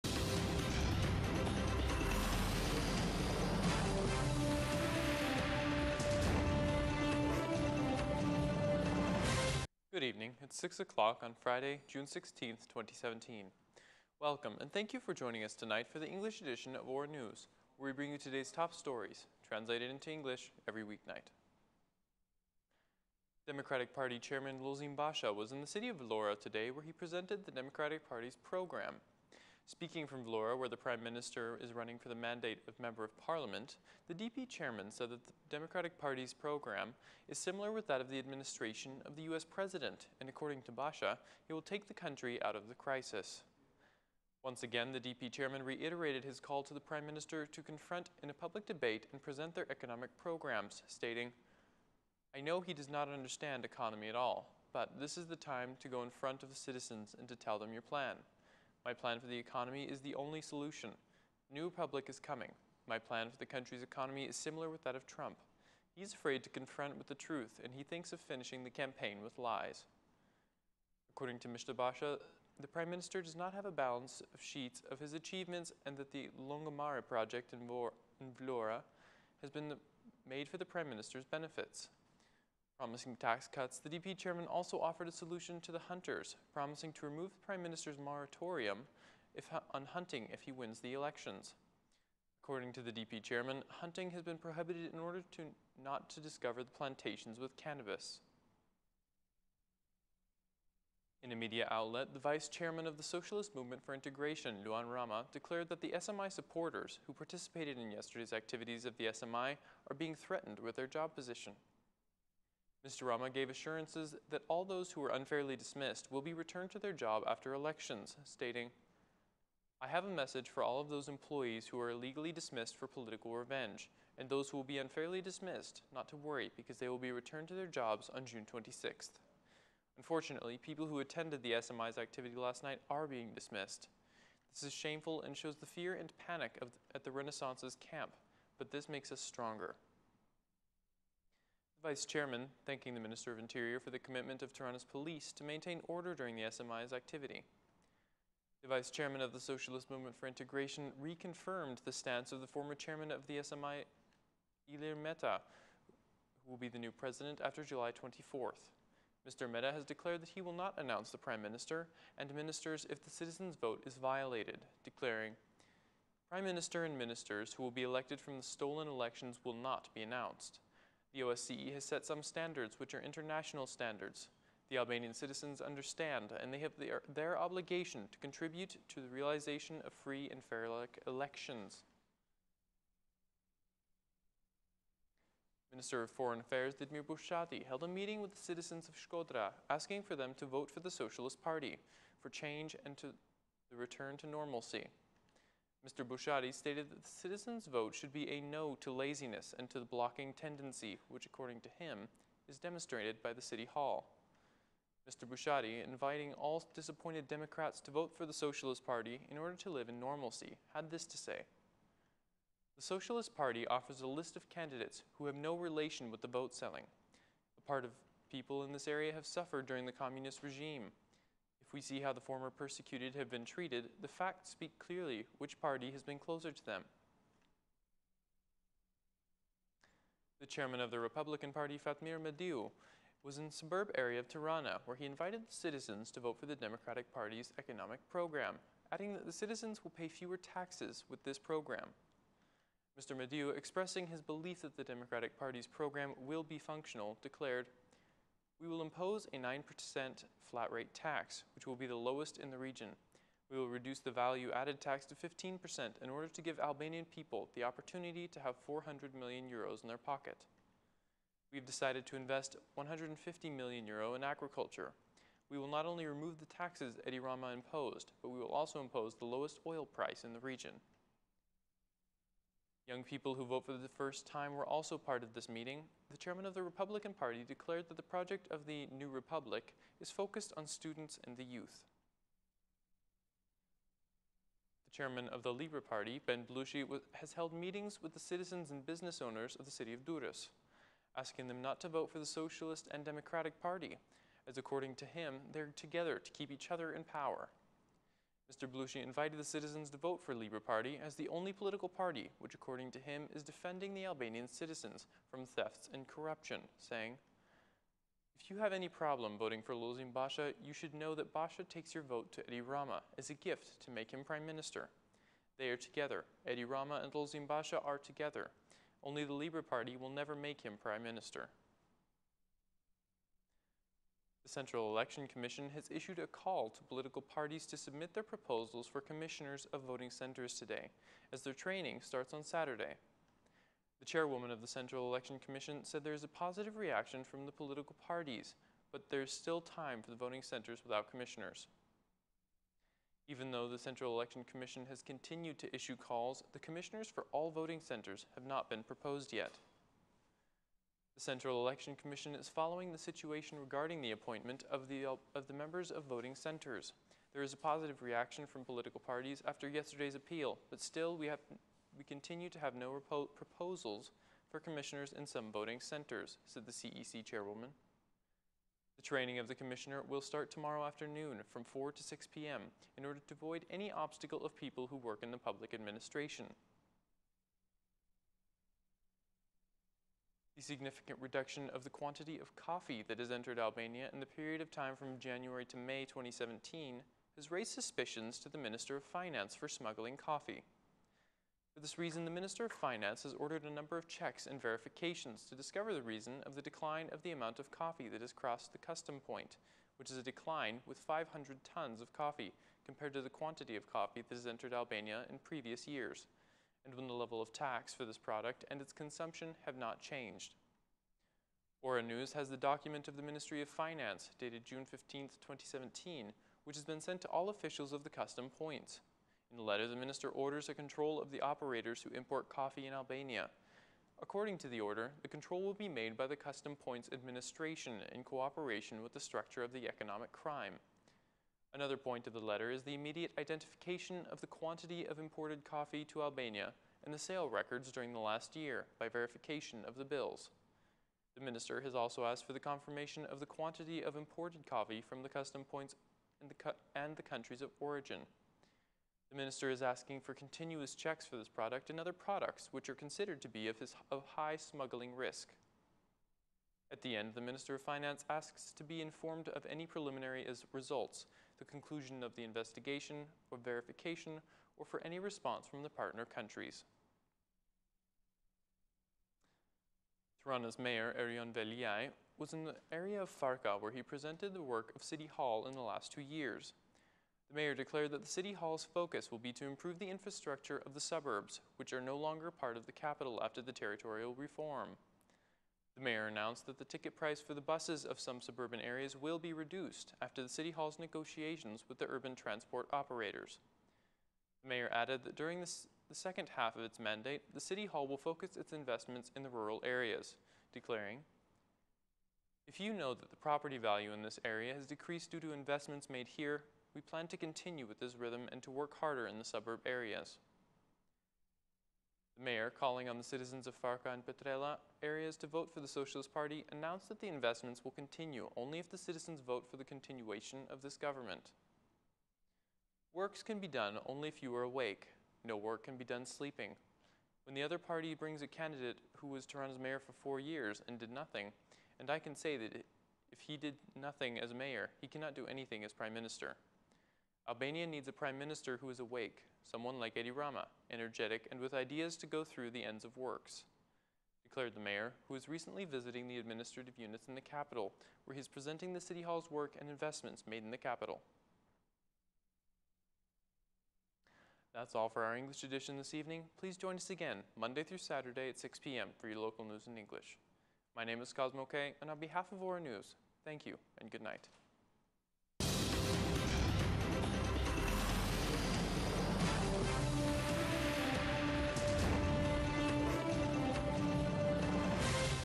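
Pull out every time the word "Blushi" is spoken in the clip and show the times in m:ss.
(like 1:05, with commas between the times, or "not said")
4:46, 4:58.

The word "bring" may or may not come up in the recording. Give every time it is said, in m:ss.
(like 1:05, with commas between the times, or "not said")
0:17, 8:48.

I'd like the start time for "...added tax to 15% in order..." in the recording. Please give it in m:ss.
4:14.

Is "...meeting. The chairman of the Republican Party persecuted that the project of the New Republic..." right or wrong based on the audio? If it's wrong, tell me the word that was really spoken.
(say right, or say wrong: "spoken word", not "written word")
wrong: "declared", not "persecuted".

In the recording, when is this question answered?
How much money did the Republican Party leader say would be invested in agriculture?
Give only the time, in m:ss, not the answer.
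4:22.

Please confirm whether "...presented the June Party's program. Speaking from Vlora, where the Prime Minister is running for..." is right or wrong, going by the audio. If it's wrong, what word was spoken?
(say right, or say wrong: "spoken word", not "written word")
wrong: "Democratic", not "June".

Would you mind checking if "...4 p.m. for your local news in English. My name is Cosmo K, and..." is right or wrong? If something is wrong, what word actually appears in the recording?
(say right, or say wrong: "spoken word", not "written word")
wrong: "6", not "4".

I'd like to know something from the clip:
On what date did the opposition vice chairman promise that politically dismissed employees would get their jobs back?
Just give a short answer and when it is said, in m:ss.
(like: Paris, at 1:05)
June 26, at 2:08.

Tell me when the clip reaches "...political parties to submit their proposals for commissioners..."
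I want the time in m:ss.
5:26.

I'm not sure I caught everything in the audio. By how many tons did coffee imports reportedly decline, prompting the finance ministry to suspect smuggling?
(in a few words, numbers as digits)
500 tons.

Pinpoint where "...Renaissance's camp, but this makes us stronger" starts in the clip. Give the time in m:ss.
2:17.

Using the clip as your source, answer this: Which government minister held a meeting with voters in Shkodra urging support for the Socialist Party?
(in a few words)
Ditmir Bushati.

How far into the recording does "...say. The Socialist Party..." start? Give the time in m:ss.
3:31.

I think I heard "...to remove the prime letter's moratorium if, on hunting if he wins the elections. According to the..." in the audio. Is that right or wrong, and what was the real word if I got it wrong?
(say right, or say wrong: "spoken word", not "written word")
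wrong: "minister", not "letter".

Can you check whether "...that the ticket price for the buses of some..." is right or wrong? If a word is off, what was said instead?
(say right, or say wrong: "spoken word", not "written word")
right.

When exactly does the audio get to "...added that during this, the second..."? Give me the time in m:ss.
8:14.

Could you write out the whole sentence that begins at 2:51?
The OSCE has set some standards which are international standards.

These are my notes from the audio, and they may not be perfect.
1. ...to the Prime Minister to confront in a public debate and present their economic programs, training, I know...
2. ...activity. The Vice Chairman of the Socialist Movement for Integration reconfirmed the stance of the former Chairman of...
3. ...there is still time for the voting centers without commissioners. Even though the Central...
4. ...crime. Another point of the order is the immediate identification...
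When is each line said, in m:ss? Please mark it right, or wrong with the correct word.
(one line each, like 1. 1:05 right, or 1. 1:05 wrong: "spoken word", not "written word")
1. 0:46 wrong: "stating", not "training"
2. 2:26 right
3. 5:39 right
4. 7:10 wrong: "letter", not "order".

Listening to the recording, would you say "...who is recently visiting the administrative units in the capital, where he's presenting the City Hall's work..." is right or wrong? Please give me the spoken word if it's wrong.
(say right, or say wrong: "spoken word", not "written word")
right.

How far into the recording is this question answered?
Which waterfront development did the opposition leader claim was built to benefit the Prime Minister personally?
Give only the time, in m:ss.
1:16.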